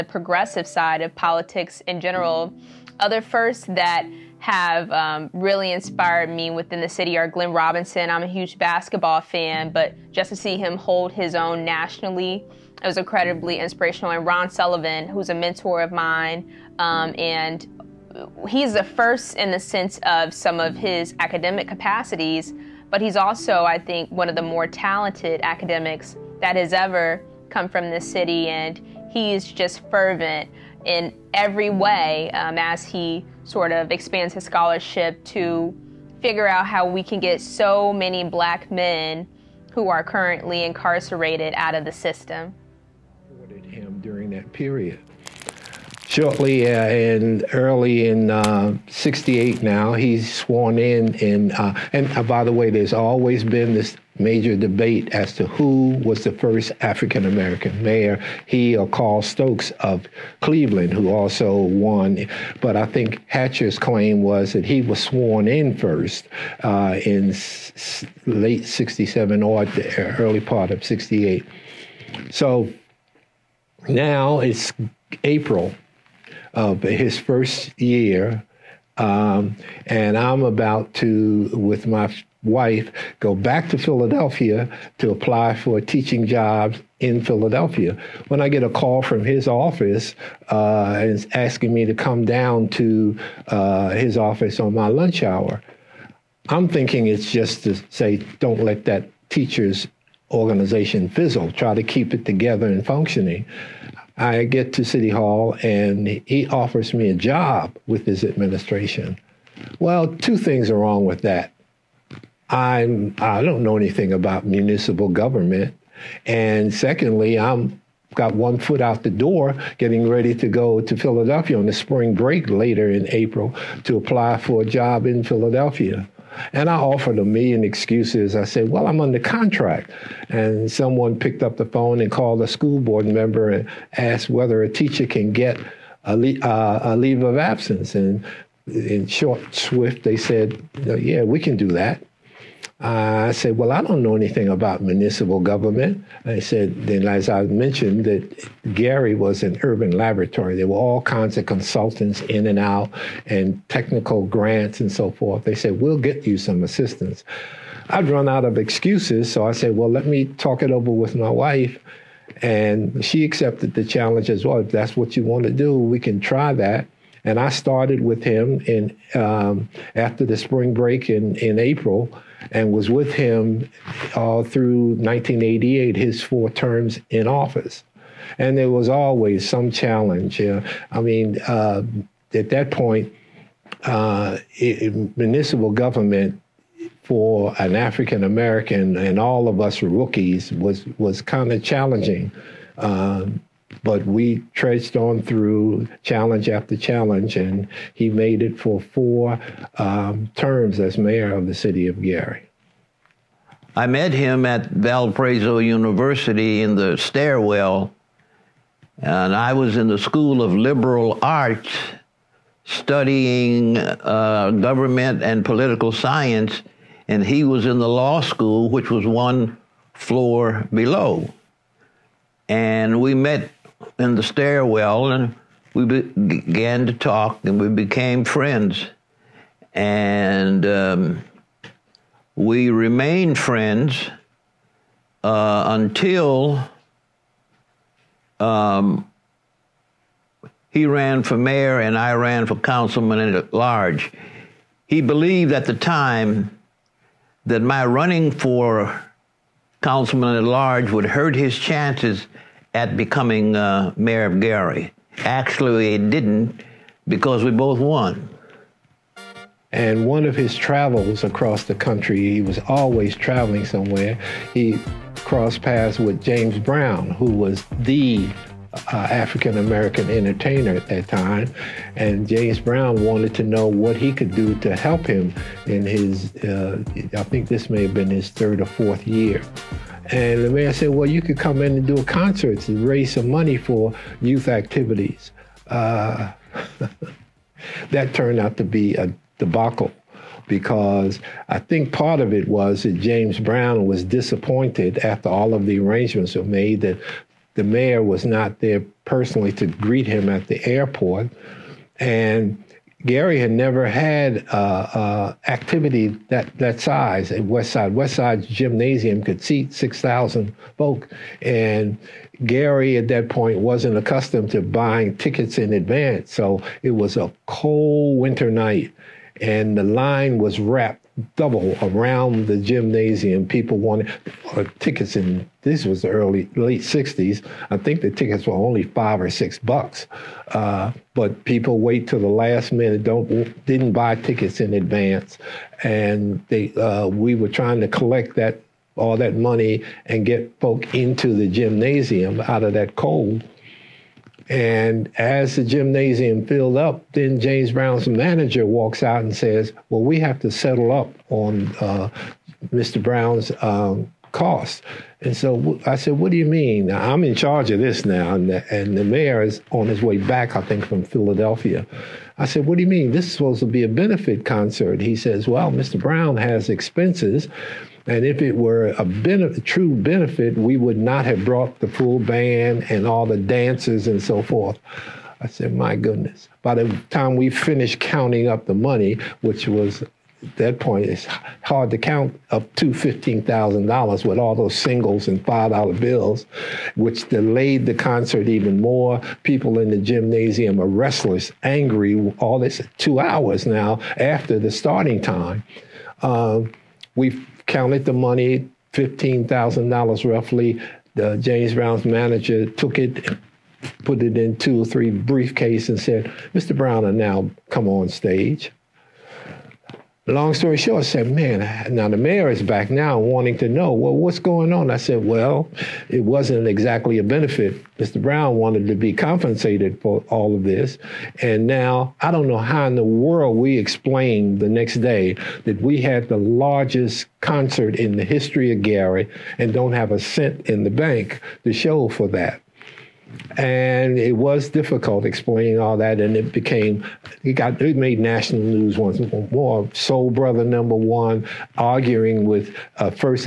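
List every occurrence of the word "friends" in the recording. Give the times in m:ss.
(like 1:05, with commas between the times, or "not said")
3:48, 3:53.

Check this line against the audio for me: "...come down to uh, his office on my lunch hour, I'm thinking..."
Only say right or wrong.
right.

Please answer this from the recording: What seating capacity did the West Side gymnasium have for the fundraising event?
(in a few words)
6,000.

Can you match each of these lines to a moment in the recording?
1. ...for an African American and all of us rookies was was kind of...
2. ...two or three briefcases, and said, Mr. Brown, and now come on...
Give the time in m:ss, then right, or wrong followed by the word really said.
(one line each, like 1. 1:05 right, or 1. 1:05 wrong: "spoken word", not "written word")
1. 3:07 right
2. 6:44 right.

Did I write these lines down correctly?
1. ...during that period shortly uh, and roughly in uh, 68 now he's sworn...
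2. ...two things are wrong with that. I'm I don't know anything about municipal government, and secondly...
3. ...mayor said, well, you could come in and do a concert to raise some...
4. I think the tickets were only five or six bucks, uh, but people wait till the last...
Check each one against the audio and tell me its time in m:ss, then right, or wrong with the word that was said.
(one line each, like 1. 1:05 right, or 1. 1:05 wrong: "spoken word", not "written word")
1. 0:44 wrong: "early", not "roughly"
2. 1:50 right
3. 4:40 right
4. 5:27 right.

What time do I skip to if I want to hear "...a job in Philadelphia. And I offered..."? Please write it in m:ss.
2:04.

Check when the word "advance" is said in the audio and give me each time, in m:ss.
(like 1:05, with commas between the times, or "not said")
5:15, 5:34.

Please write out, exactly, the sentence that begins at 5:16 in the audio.
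So it was a cold winter night and the line was wrapped double around the gymnasium.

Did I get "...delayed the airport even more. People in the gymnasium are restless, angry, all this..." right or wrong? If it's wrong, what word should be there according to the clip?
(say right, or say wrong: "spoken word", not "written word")
wrong: "concert", not "airport".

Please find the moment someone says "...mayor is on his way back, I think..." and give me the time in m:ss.
5:59.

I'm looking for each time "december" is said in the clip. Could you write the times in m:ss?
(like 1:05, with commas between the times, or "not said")
not said.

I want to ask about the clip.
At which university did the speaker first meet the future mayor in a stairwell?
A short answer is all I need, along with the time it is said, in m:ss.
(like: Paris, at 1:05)
Valparaiso University, at 3:24.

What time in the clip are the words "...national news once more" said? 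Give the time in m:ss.
7:18.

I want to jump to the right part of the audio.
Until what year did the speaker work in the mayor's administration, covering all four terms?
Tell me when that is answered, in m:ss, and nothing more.
2:54.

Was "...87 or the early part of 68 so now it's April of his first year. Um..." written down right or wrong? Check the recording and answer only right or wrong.
wrong.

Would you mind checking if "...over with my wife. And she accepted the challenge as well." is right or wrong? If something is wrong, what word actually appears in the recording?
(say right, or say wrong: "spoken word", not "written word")
right.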